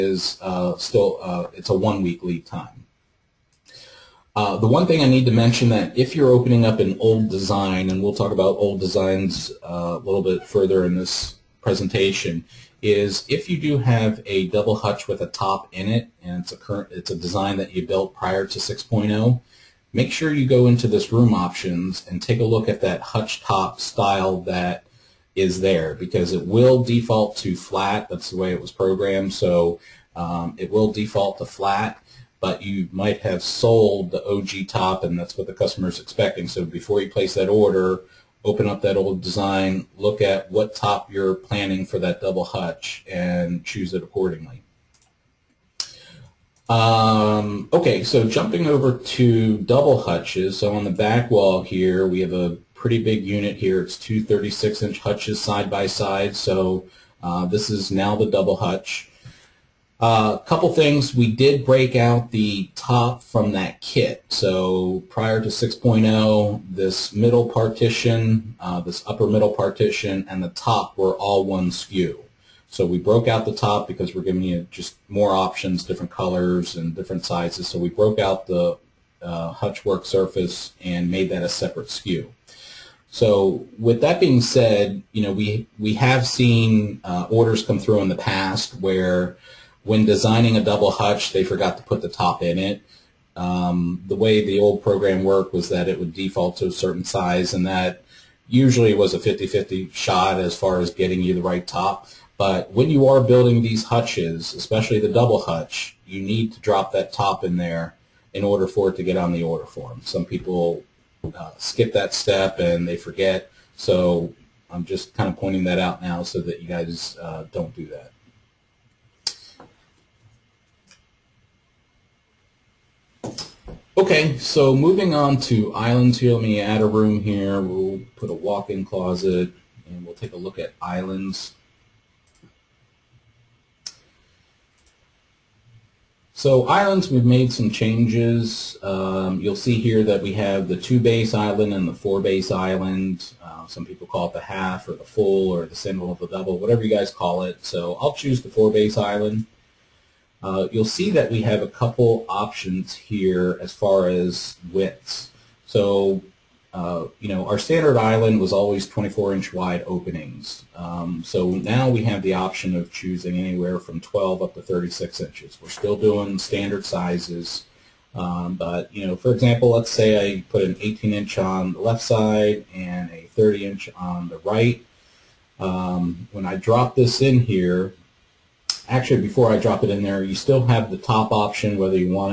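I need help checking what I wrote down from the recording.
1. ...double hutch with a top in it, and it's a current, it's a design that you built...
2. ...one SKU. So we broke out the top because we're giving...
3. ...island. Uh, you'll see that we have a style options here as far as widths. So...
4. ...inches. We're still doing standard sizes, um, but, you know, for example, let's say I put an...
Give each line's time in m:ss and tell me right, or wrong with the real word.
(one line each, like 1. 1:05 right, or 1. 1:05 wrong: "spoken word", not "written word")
1. 0:14 right
2. 1:11 right
3. 2:28 wrong: "couple", not "style"
4. 2:45 right.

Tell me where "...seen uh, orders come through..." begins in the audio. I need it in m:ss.
1:26.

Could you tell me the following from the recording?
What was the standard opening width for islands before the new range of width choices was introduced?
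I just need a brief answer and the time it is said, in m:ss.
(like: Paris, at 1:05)
24 inches, at 2:38.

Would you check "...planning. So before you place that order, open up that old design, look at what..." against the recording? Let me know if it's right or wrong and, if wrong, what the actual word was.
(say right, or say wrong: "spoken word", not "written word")
wrong: "expecting", not "planning".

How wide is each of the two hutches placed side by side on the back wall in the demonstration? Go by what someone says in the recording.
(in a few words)
36 inches.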